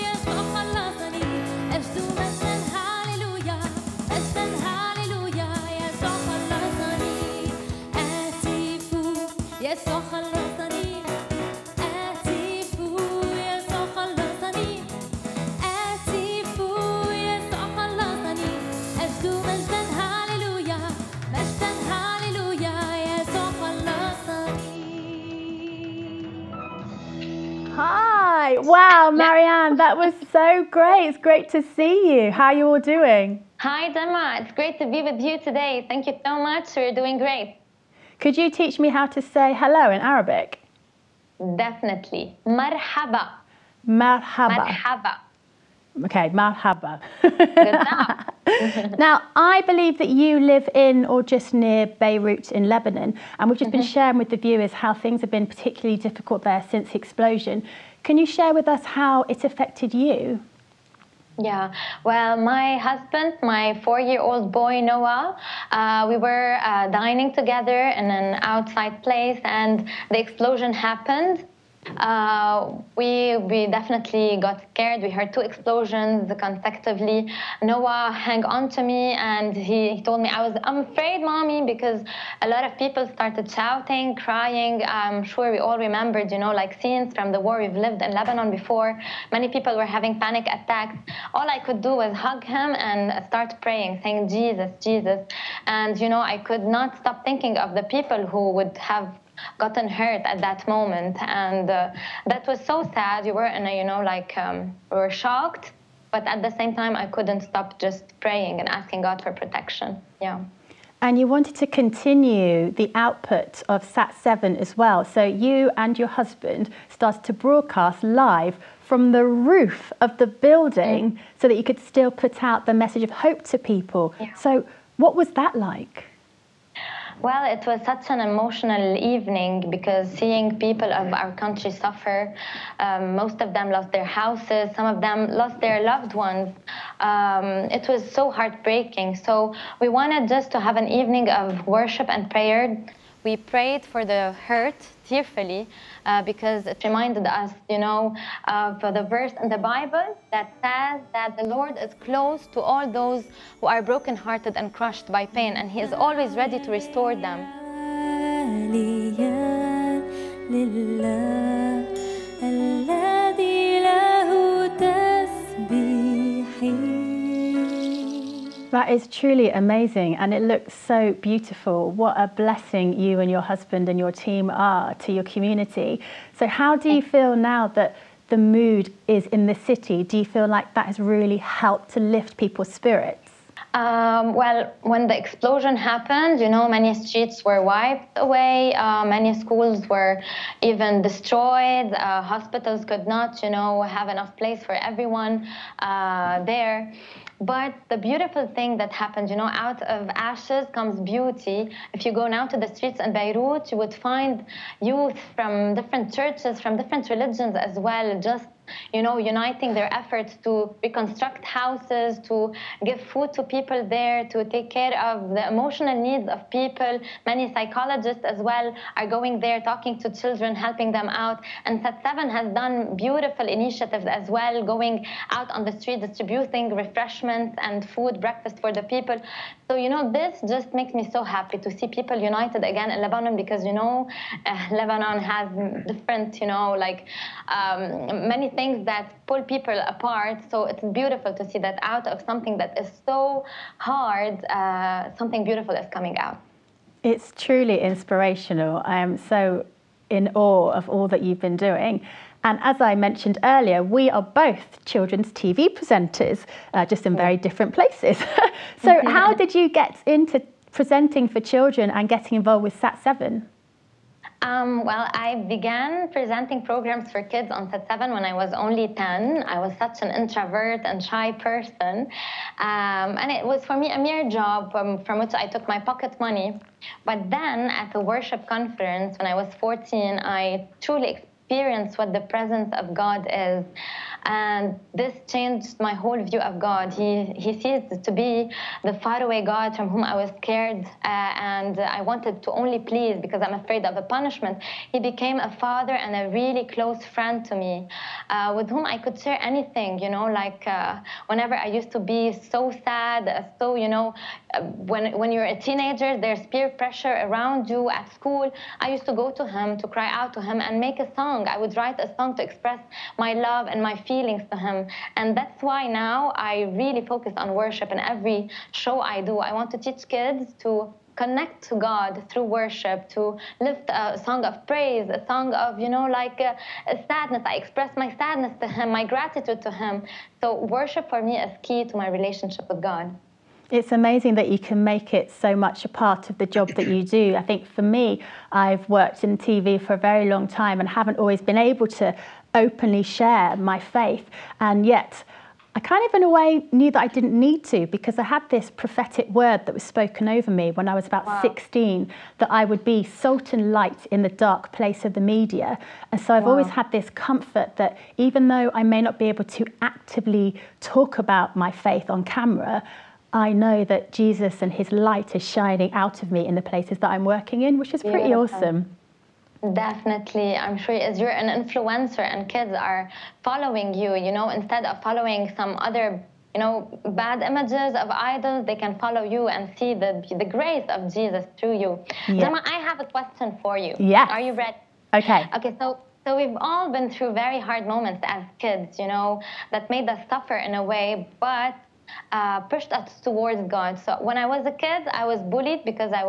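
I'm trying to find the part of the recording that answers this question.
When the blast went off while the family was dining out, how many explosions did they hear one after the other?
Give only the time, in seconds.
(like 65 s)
75 s.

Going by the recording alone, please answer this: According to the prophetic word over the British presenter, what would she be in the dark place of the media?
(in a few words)
Salt and light.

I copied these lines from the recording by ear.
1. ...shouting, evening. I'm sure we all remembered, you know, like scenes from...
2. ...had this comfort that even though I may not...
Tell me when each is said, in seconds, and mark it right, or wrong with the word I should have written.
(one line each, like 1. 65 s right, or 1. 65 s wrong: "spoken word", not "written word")
1. 83 s wrong: "crying", not "evening"
2. 356 s right.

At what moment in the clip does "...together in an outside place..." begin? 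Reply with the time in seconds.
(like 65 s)
67 s.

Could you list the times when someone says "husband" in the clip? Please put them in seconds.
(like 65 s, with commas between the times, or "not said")
62 s, 116 s, 173 s.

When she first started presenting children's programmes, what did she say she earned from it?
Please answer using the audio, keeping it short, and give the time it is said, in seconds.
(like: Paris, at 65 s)
Pocket money, at 275 s.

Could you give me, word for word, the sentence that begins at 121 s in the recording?
so that you could still put out the message of hope to people.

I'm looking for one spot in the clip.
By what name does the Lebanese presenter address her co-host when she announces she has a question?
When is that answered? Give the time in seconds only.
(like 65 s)
382 s.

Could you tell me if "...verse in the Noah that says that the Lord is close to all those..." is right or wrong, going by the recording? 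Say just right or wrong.
wrong.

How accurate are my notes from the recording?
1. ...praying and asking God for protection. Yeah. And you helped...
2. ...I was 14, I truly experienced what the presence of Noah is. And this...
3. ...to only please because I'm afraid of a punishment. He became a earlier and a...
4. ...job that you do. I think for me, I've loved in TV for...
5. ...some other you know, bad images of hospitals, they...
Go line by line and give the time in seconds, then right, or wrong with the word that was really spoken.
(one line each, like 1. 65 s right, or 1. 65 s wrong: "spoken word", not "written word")
1. 108 s wrong: "wanted", not "helped"
2. 279 s wrong: "God", not "Noah"
3. 292 s wrong: "father", not "earlier"
4. 336 s wrong: "worked", not "loved"
5. 375 s wrong: "idols", not "hospitals".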